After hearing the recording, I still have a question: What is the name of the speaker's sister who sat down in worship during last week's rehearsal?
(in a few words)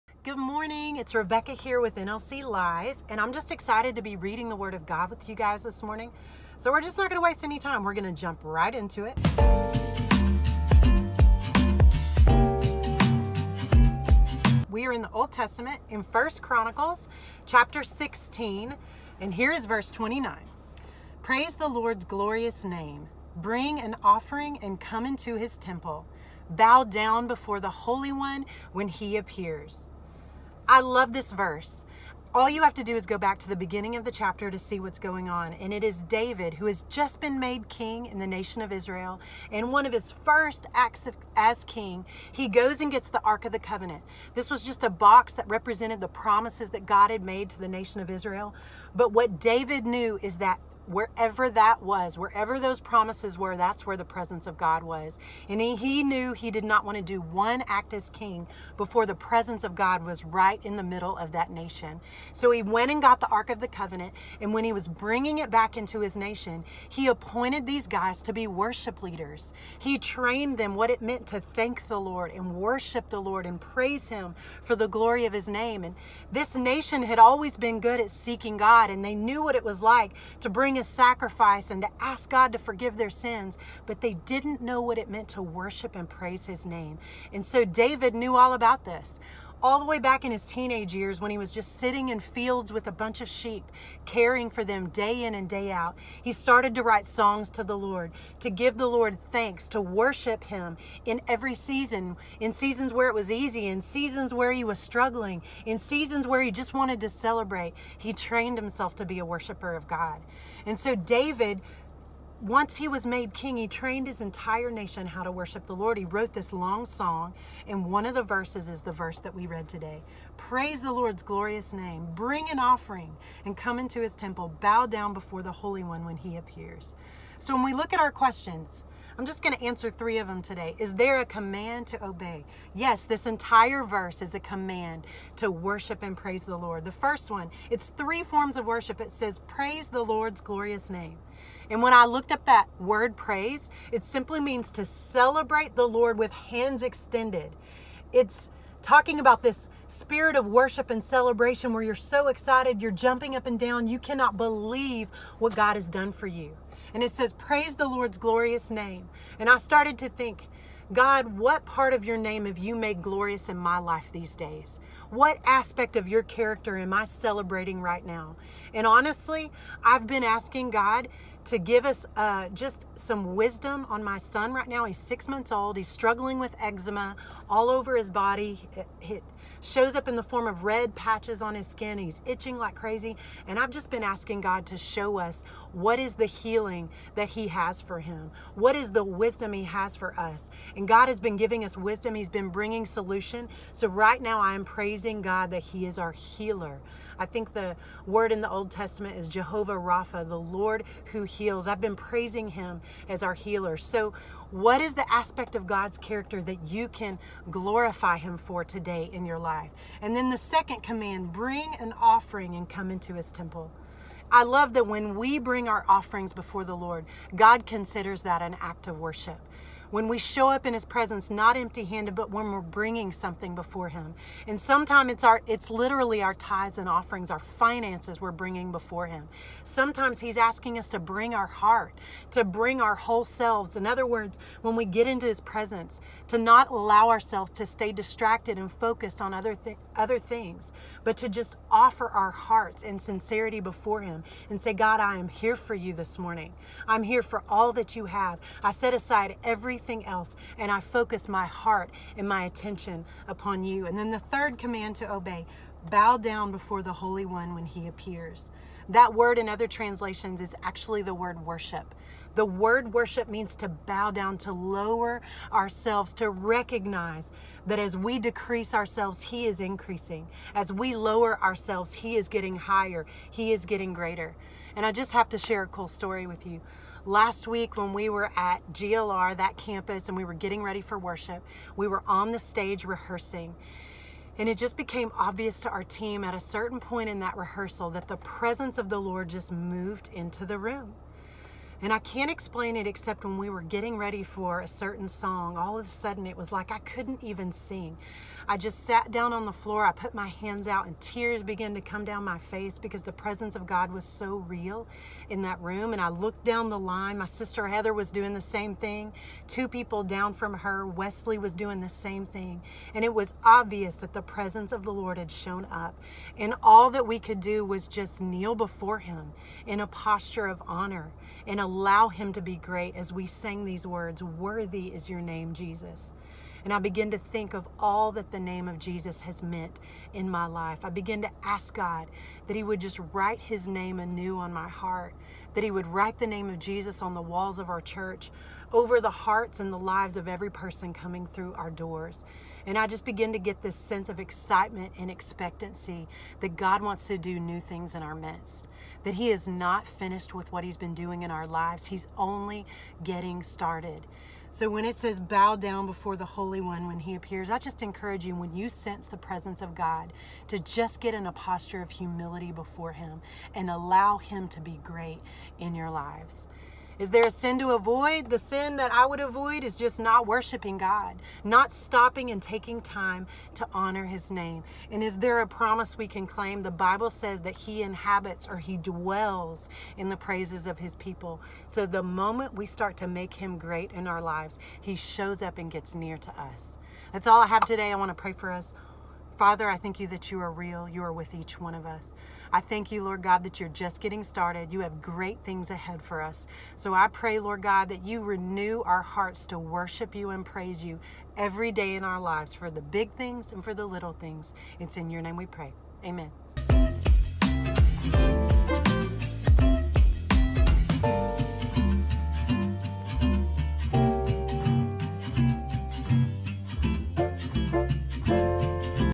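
Heather.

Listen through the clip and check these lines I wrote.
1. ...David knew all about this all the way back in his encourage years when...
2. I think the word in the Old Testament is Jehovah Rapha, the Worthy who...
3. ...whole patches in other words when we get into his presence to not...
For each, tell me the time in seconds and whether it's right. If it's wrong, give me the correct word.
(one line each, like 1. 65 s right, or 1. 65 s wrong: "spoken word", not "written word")
1. 87 s wrong: "teenage", not "encourage"
2. 197 s wrong: "Lord", not "Worthy"
3. 232 s wrong: "selves", not "patches".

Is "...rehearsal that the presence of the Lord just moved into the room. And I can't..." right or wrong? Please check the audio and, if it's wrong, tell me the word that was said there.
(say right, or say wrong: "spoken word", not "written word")
right.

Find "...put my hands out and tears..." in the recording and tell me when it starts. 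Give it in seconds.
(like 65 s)
299 s.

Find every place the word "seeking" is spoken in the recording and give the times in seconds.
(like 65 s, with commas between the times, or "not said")
78 s.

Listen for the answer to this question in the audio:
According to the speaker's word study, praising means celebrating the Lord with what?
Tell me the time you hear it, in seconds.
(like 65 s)
146 s.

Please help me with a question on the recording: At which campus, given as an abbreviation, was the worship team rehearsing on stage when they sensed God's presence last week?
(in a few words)
GLR.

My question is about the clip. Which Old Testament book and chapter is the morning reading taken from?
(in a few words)
1 Chronicles chapter 16.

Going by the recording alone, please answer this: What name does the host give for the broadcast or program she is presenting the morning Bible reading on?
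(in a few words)
NLC Live.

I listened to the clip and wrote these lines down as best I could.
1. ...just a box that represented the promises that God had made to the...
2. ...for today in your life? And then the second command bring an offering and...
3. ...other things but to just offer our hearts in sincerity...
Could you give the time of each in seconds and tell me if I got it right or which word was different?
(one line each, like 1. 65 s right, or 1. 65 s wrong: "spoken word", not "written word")
1. 44 s right
2. 208 s right
3. 239 s right.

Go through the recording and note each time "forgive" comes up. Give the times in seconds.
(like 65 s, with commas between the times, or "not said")
82 s.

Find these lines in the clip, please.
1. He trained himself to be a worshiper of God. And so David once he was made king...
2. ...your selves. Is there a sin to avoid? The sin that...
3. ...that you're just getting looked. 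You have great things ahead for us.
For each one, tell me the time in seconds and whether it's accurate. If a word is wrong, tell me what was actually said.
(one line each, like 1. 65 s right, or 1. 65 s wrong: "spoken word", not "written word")
1. 107 s right
2. 365 s wrong: "lives", not "selves"
3. 393 s wrong: "started", not "looked".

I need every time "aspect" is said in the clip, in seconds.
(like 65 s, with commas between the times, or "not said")
165 s, 205 s.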